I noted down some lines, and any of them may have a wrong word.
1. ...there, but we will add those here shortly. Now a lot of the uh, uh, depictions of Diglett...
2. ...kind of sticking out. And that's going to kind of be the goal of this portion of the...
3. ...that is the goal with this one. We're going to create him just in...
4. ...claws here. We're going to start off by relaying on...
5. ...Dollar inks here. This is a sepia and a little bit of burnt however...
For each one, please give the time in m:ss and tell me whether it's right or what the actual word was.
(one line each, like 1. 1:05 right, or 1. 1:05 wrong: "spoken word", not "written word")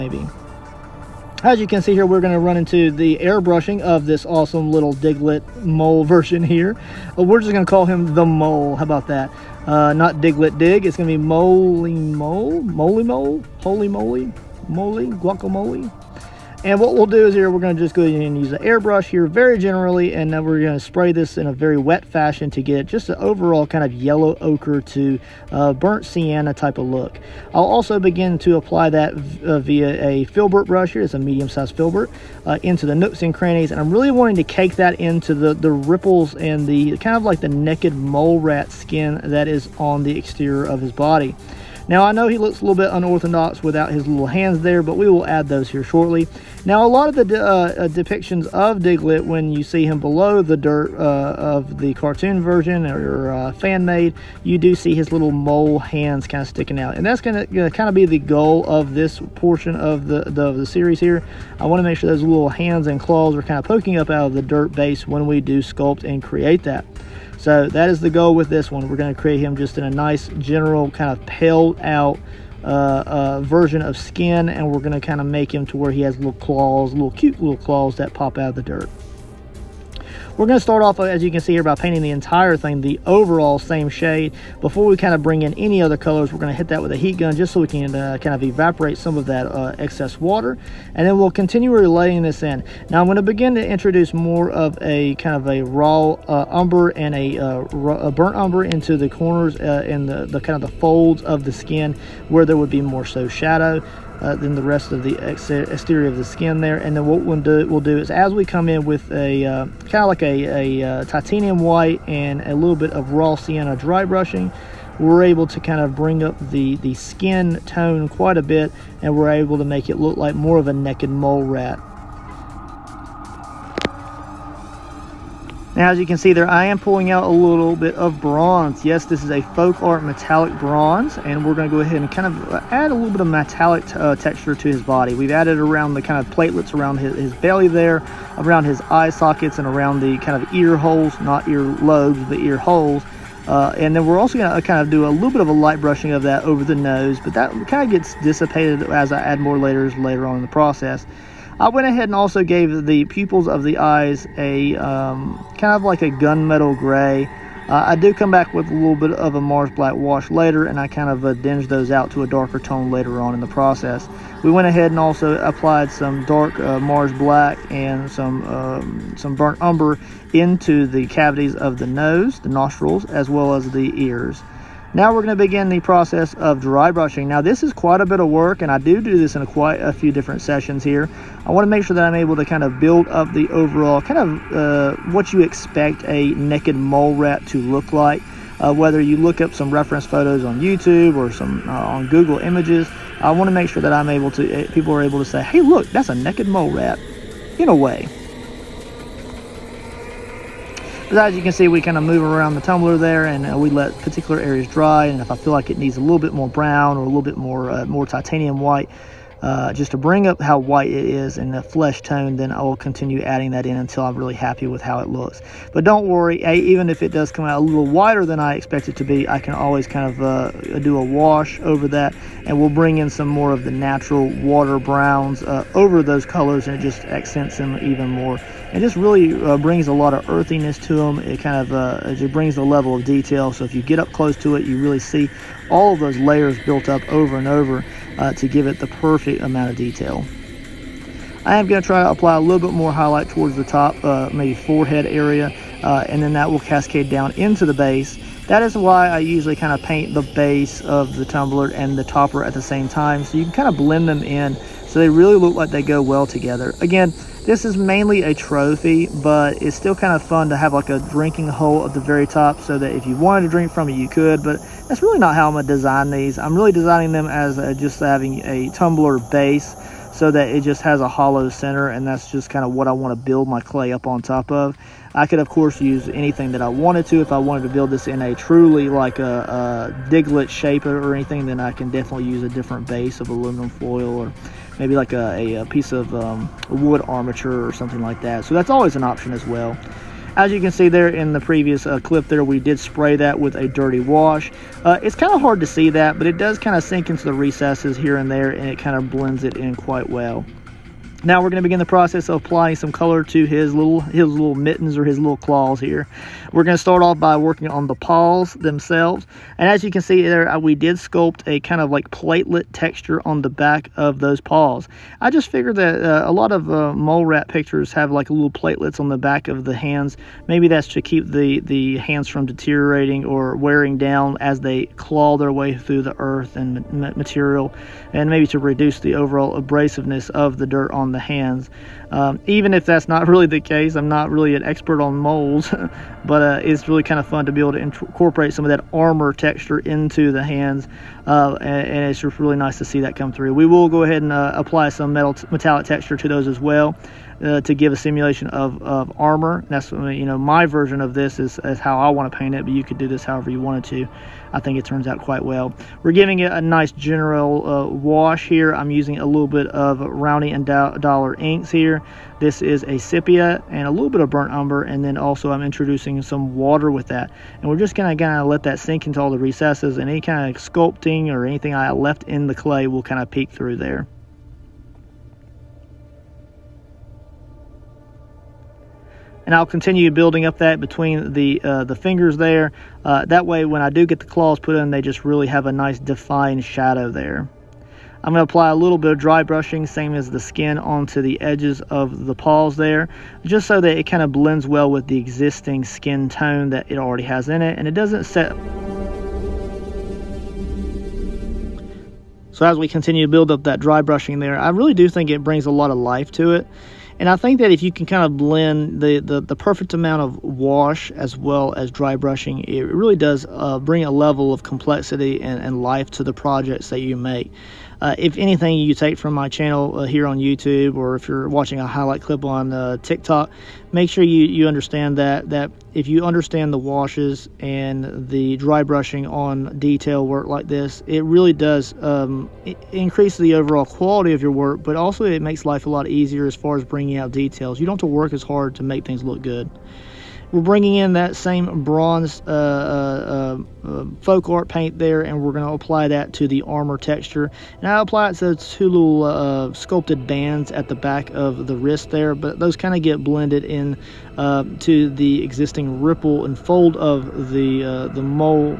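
1. 0:44 right
2. 0:56 right
3. 1:07 right
4. 5:05 wrong: "working", not "relaying"
5. 6:00 wrong: "umber", not "however".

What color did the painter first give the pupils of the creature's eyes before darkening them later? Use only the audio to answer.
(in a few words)
Gunmetal gray.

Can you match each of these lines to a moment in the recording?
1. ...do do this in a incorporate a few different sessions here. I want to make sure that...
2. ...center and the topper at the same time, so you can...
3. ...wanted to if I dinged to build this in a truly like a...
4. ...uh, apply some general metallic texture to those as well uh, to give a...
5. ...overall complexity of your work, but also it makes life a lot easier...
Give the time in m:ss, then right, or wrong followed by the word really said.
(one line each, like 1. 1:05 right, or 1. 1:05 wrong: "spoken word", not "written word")
1. 2:58 wrong: "quite", not "incorporate"
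2. 4:11 wrong: "tumbler", not "center"
3. 4:36 wrong: "wanted", not "dinged"
4. 5:44 wrong: "metal", not "general"
5. 7:13 wrong: "quality", not "complexity".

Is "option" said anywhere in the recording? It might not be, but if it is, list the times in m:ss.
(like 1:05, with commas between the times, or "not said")
4:49.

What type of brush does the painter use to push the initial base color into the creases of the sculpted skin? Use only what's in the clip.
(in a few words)
Filbert brush.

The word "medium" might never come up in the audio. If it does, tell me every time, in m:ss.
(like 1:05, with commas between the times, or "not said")
0:31.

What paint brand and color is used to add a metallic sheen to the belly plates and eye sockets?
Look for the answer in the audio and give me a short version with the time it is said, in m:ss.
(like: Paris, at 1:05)
Folk Art Metallic Bronze, at 2:09.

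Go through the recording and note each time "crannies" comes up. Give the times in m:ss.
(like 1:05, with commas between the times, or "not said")
0:33.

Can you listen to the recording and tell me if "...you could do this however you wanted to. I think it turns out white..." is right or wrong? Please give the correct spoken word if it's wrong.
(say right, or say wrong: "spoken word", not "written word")
wrong: "quite", not "white".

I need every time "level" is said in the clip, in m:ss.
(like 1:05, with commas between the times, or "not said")
3:52, 6:54.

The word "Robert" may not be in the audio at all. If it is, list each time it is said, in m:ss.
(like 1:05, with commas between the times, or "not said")
not said.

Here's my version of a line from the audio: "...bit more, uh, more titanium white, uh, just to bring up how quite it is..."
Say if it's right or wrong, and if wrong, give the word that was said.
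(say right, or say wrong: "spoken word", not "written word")
wrong: "white", not "quite".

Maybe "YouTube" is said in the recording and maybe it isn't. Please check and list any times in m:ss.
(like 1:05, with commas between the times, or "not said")
3:10, 7:00.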